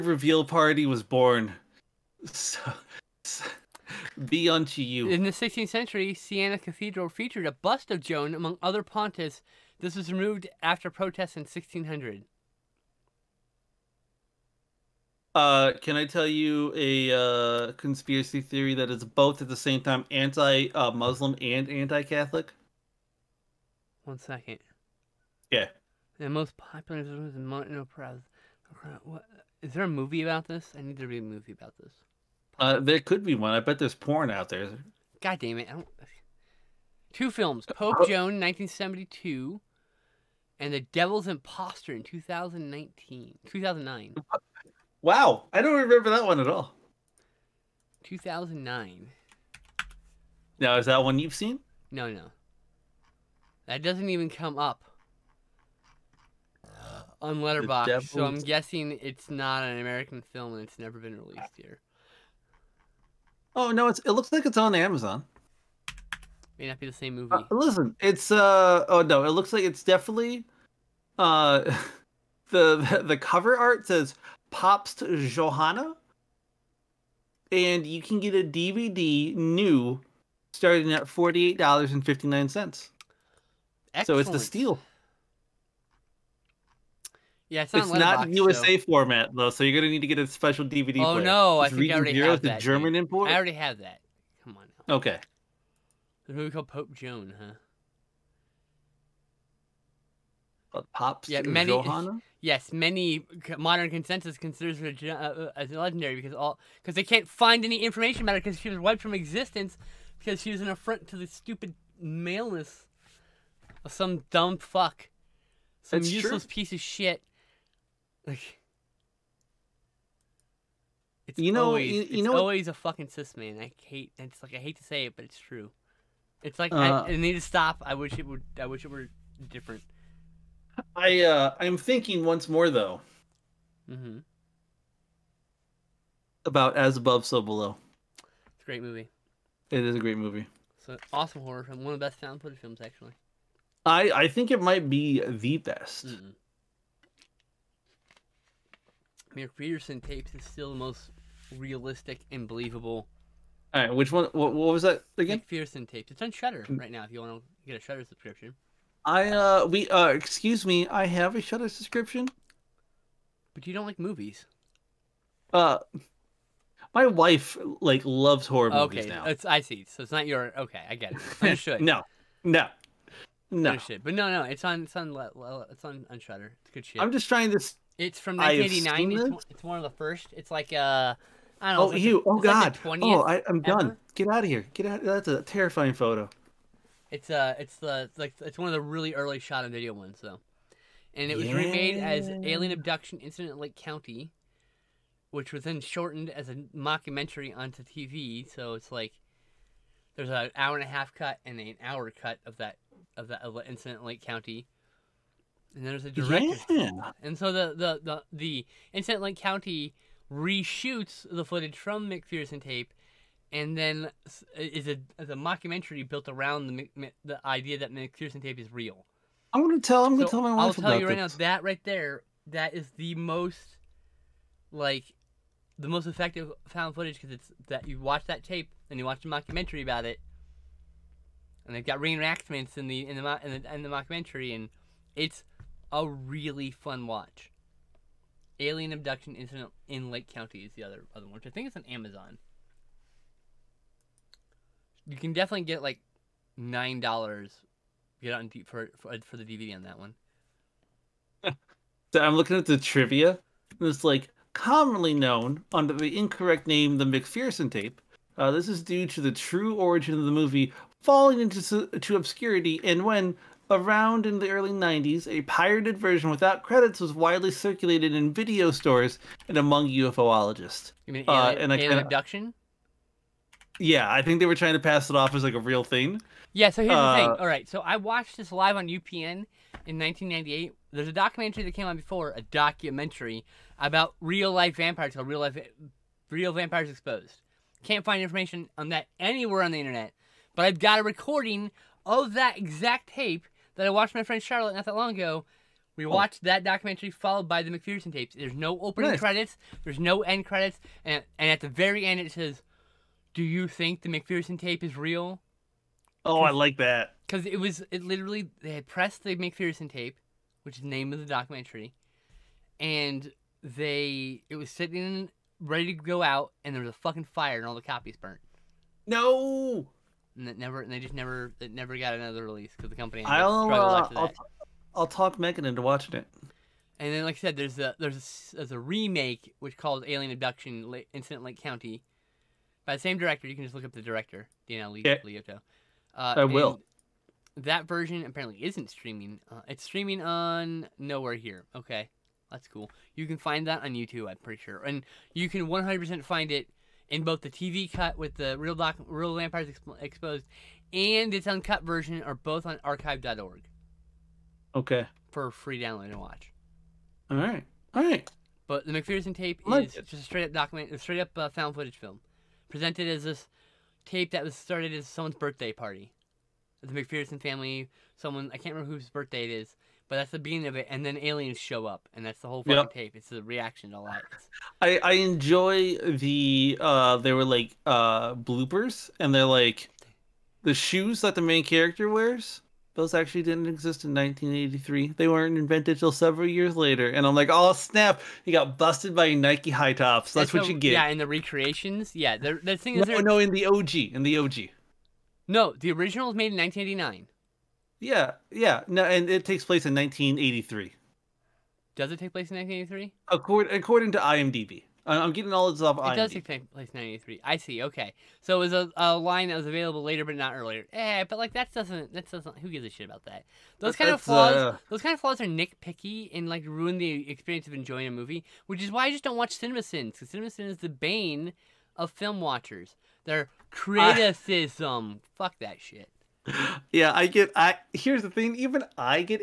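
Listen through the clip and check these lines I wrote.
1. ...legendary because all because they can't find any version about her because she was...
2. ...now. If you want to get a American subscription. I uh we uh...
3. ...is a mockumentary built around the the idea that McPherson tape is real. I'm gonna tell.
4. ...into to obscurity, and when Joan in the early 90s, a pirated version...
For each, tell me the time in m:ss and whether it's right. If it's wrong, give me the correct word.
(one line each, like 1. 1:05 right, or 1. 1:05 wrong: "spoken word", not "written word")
1. 1:45 wrong: "information", not "version"
2. 2:36 wrong: "Shudder", not "American"
3. 3:35 right
4. 4:21 wrong: "Around", not "Joan".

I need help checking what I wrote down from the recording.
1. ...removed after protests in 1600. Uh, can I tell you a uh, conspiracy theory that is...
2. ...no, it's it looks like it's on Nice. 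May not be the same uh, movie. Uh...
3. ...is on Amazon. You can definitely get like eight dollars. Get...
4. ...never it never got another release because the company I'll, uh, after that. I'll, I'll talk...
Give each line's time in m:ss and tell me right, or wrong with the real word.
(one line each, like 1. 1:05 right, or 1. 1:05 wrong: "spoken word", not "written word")
1. 0:10 right
2. 1:03 wrong: "Amazon", not "Nice"
3. 4:01 wrong: "nine", not "eight"
4. 5:21 right.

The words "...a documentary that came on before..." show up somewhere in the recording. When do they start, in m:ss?
4:41.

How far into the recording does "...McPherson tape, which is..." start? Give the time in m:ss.
5:09.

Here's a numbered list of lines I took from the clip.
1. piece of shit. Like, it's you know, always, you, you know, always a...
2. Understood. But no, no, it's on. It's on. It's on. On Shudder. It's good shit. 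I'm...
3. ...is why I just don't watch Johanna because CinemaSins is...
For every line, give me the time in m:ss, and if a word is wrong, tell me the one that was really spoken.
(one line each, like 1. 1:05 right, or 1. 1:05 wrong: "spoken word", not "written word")
1. 1:56 right
2. 2:53 right
3. 6:58 wrong: "CinemaSins", not "Johanna".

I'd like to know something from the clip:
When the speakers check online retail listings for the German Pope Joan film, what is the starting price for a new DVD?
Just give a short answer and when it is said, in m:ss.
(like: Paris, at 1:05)
$48.59, at 1:21.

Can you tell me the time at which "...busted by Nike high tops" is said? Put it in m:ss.
6:28.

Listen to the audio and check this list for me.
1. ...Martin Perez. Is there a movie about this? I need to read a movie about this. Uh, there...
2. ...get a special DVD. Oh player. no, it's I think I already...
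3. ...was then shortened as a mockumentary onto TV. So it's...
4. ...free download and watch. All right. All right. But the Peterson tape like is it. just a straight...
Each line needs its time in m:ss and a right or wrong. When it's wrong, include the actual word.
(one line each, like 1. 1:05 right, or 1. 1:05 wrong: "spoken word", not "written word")
1. 0:27 right
2. 1:30 right
3. 3:15 right
4. 5:55 wrong: "McPherson", not "Peterson".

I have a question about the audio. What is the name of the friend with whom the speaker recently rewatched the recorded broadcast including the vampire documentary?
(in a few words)
Charlotte.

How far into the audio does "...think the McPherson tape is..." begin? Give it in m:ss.
5:03.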